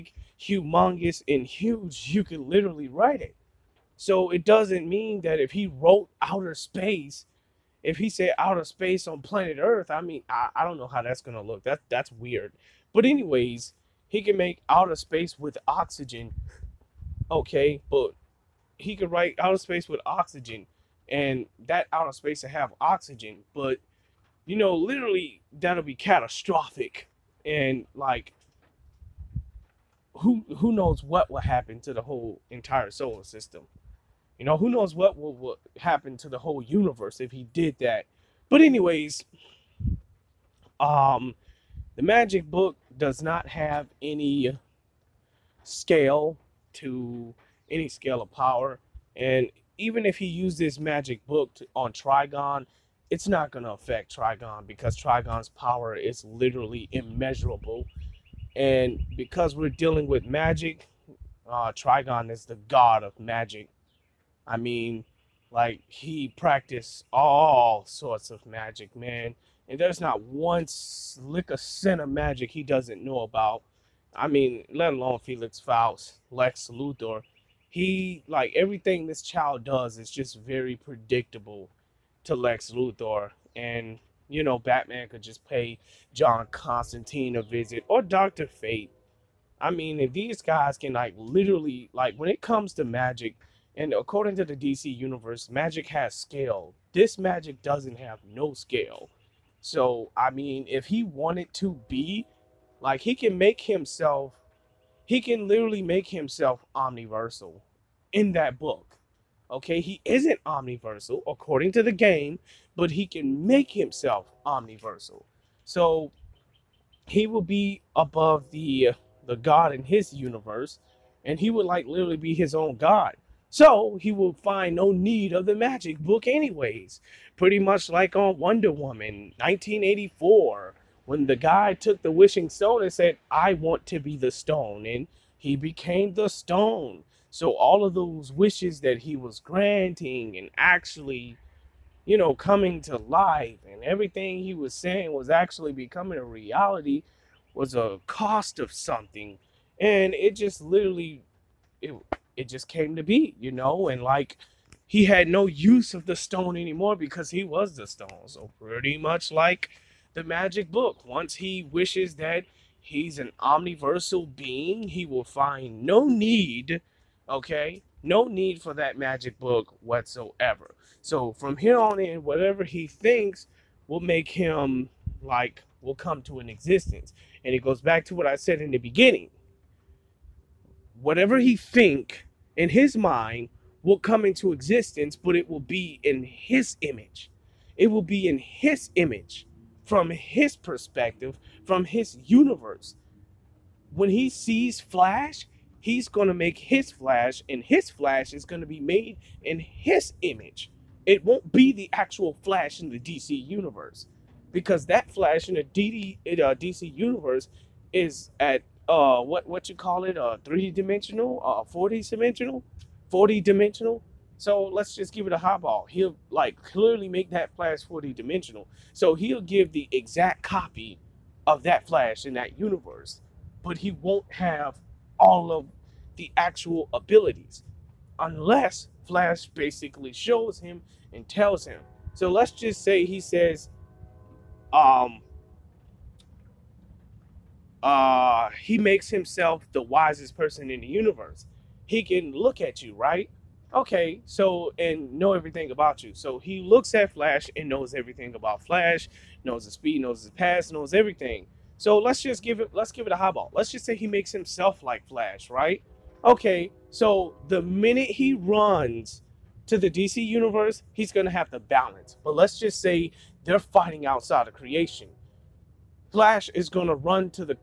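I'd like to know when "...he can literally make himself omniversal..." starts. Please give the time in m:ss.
1:45.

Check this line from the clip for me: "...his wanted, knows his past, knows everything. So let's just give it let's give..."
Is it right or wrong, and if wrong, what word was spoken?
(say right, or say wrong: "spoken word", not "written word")
wrong: "speed", not "wanted".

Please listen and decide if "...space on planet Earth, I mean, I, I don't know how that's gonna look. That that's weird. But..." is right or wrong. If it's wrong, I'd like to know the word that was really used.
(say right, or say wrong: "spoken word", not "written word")
right.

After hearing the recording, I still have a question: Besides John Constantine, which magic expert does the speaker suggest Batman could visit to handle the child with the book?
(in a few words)
Dr. Fate.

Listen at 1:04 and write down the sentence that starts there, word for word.
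I mean, like, he practiced all sorts of magic, man.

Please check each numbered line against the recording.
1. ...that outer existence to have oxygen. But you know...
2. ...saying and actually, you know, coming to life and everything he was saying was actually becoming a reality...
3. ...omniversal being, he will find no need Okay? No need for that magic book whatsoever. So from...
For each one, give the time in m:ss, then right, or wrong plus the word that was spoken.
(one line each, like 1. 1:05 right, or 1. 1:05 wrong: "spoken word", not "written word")
1. 0:21 wrong: "space", not "existence"
2. 2:19 wrong: "granting", not "saying"
3. 2:43 right.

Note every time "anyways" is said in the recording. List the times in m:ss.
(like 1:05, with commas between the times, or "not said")
0:13, 0:38, 2:06.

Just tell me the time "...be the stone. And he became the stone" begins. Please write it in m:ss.
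2:13.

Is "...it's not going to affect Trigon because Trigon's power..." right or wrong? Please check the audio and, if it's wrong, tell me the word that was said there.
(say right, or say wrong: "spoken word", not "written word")
right.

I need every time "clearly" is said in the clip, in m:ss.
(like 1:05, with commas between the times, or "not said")
3:36.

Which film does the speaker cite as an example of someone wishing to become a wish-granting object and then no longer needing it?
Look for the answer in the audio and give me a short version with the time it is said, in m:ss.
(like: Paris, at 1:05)
Wonder Woman 1984, at 2:08.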